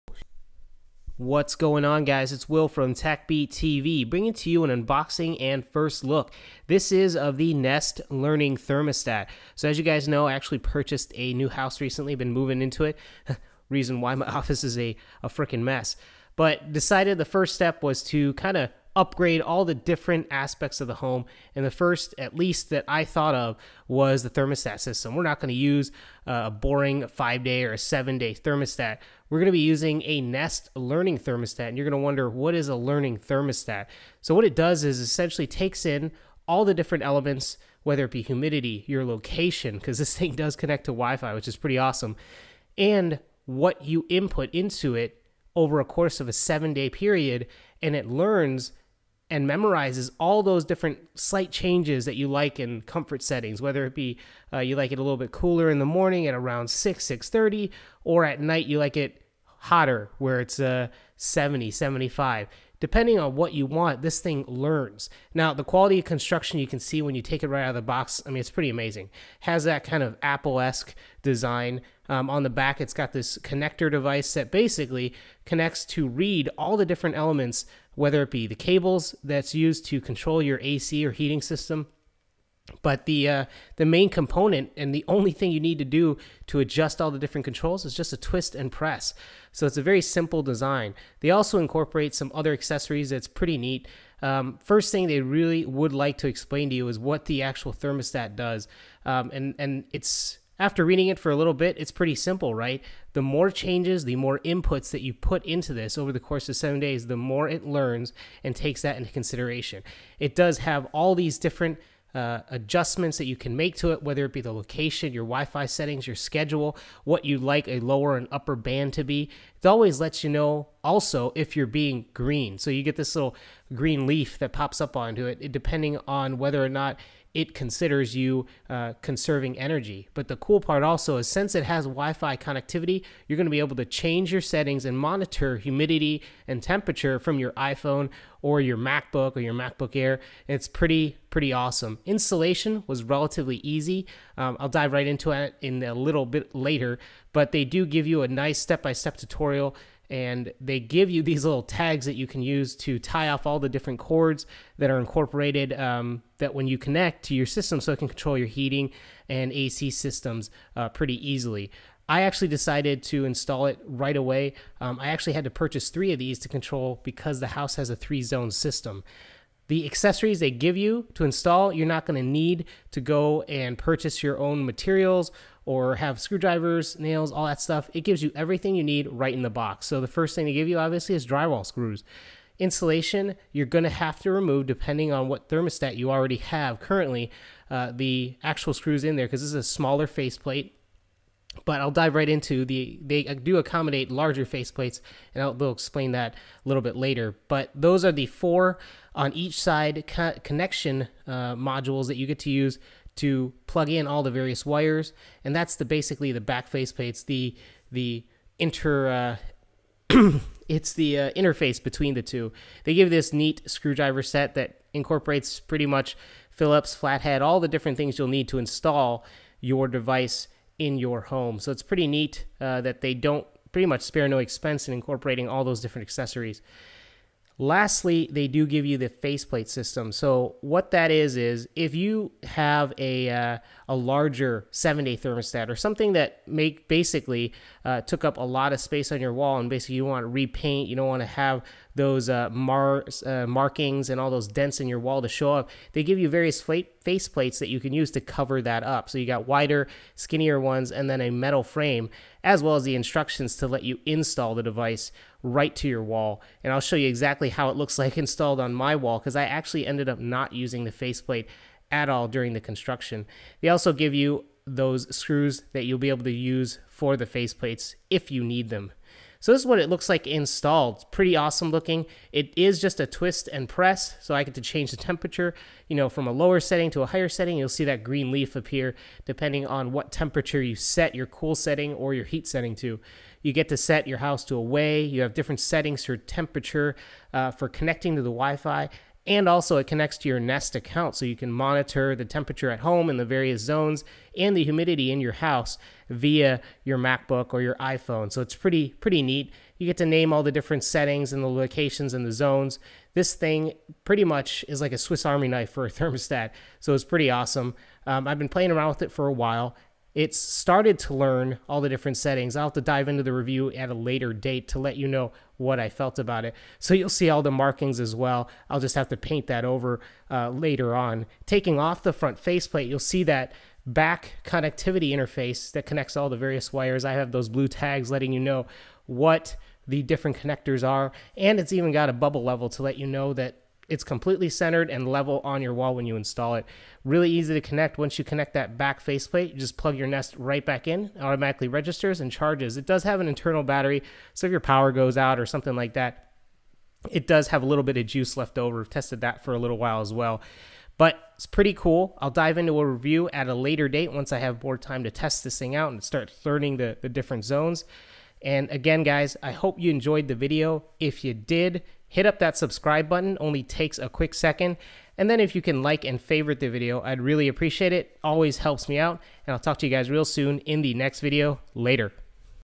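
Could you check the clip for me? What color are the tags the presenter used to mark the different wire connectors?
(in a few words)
blue.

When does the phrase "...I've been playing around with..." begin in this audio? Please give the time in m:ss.
5:08.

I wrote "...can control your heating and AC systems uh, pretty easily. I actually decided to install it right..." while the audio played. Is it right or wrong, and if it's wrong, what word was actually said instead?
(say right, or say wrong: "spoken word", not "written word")
right.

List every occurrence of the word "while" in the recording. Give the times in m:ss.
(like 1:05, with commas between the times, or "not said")
5:09, 5:49.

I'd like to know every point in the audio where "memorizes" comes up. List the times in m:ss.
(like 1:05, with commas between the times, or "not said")
0:49.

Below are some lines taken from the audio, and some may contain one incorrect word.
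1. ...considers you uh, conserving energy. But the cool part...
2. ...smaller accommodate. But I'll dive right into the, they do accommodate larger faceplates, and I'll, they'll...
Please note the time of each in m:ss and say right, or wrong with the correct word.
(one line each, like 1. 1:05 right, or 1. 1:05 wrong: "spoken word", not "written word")
1. 2:07 right
2. 3:09 wrong: "faceplate", not "accommodate".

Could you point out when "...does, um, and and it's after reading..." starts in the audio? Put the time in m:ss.
1:38.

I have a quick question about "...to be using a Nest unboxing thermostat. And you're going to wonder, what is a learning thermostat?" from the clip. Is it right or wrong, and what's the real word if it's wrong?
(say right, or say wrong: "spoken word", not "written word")
wrong: "learning", not "unboxing".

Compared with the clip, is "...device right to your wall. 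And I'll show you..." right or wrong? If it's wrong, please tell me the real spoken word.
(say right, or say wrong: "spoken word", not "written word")
right.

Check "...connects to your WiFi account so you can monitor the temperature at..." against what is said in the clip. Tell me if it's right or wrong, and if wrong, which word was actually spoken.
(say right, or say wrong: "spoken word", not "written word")
wrong: "Nest", not "WiFi".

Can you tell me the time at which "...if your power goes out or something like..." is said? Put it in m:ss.
5:44.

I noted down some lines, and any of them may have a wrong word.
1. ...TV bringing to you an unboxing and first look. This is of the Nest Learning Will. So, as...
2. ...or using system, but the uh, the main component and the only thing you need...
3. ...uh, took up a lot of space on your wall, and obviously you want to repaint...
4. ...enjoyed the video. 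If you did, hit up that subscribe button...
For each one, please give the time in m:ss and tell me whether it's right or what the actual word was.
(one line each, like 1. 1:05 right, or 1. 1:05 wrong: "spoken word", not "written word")
1. 0:03 wrong: "Thermostat", not "Will"
2. 1:21 wrong: "heating", not "using"
3. 3:57 wrong: "basically", not "obviously"
4. 5:59 right.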